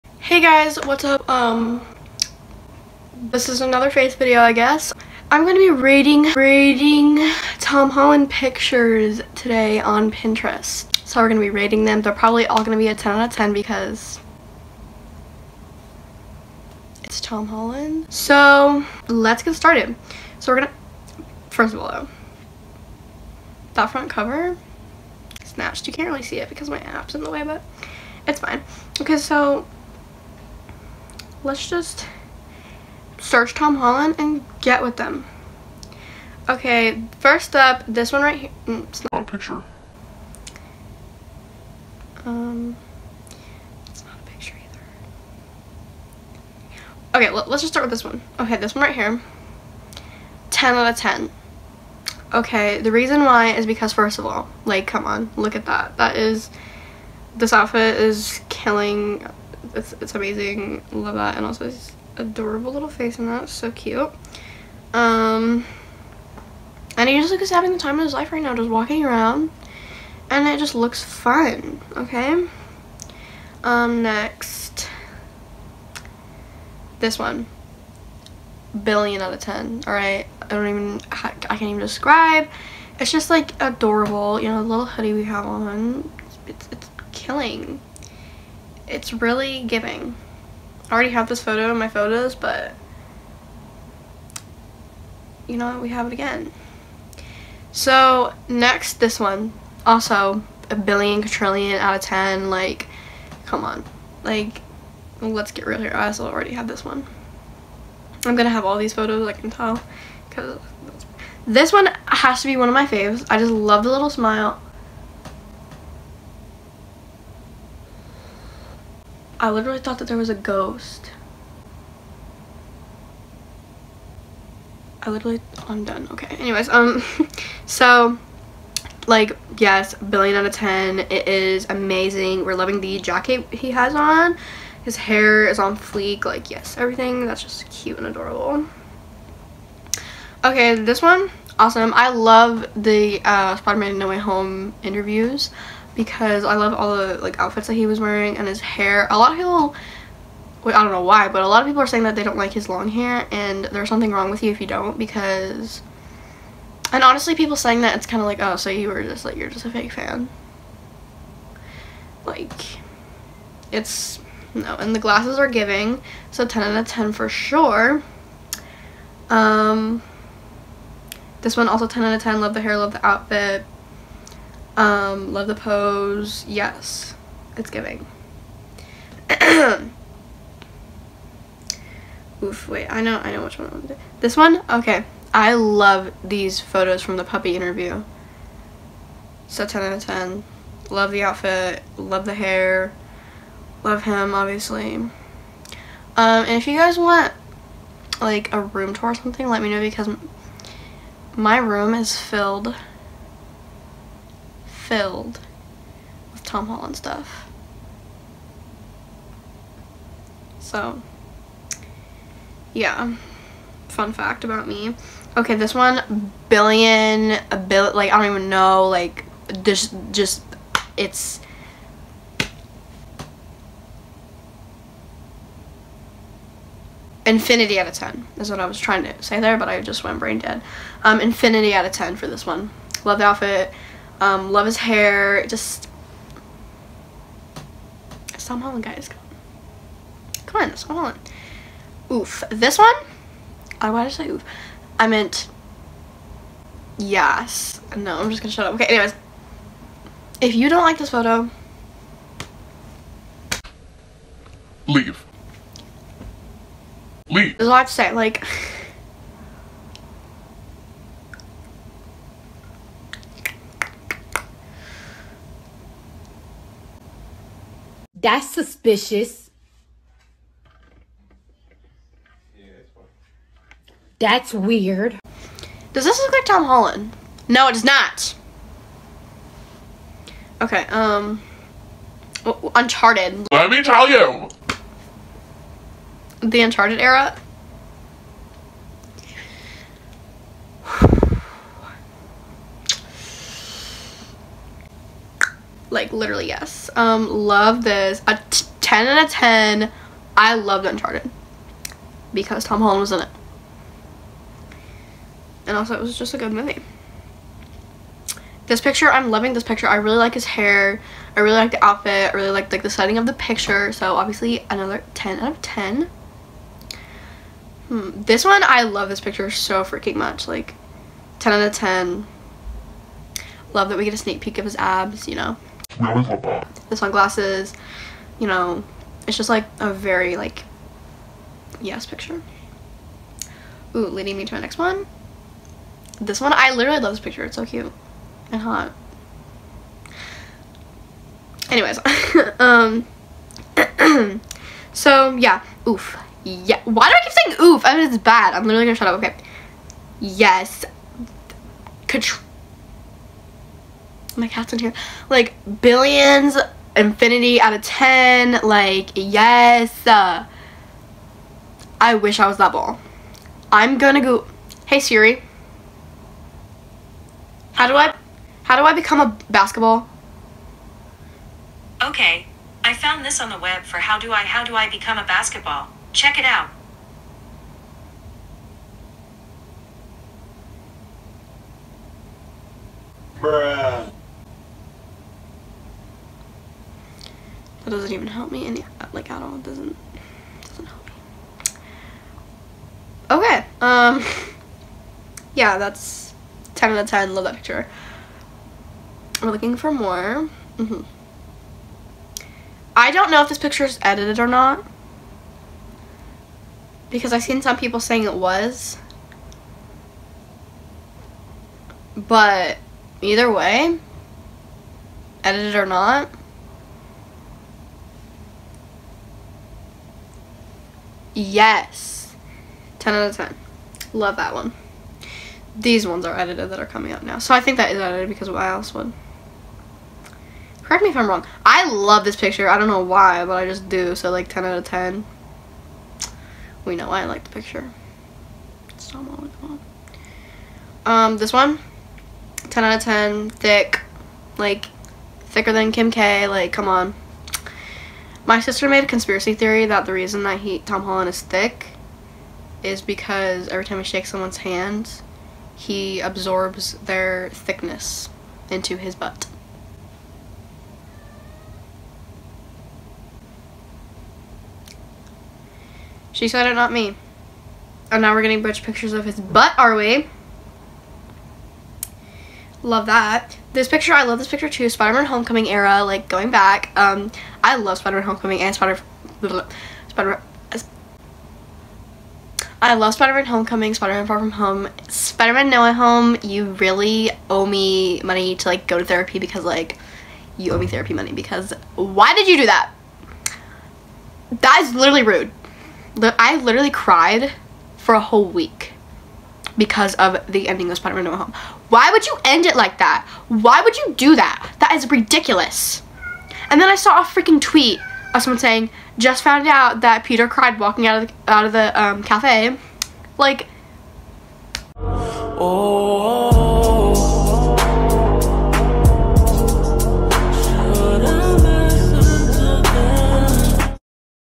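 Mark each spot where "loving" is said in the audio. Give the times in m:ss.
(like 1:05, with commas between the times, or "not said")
2:12, 5:09.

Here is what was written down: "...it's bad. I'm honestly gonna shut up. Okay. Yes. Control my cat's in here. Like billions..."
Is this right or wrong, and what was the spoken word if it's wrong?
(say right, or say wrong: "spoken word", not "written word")
wrong: "literally", not "honestly".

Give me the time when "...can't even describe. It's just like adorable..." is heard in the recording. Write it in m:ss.
1:21.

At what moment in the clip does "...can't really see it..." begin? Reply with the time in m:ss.
0:25.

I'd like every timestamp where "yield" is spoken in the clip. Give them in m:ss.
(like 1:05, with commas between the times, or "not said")
not said.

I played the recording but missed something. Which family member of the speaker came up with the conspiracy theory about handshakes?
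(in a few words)
sister.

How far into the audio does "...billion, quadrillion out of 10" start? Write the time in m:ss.
1:40.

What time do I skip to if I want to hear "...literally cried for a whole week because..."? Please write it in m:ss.
8:16.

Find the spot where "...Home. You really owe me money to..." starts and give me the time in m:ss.
8:05.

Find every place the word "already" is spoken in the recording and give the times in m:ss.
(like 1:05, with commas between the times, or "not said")
1:30, 1:46.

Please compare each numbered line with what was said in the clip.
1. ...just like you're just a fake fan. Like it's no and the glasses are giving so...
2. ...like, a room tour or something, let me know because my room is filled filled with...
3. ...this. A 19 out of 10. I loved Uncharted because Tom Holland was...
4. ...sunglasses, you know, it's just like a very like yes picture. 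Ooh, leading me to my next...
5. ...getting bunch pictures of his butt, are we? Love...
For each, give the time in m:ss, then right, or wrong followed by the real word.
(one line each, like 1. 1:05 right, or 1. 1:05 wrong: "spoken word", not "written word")
1. 2:39 right
2. 3:18 right
3. 4:57 wrong: "10", not "19"
4. 5:26 right
5. 7:48 right.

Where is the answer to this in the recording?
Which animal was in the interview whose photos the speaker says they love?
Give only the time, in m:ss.
3:07.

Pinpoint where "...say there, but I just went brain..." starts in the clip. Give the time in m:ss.
3:49.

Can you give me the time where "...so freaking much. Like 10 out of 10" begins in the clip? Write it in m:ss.
5:19.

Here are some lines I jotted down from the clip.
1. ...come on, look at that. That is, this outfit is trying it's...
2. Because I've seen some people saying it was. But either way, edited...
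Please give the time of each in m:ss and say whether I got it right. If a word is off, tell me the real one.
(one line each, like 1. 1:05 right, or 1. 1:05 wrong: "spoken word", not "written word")
1. 0:54 wrong: "killing", not "trying"
2. 6:47 right.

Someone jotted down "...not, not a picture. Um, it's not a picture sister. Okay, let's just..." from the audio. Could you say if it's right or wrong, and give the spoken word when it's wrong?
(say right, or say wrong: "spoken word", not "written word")
wrong: "either", not "sister".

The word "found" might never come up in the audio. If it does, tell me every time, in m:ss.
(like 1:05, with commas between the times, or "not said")
6:12, 8:29.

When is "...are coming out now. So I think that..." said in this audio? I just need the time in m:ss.
7:06.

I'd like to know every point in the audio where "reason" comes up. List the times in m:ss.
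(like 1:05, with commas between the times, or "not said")
0:52, 7:30.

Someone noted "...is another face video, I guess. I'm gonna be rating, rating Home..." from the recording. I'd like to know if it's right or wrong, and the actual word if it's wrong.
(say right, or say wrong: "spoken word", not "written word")
wrong: "Tom", not "Home".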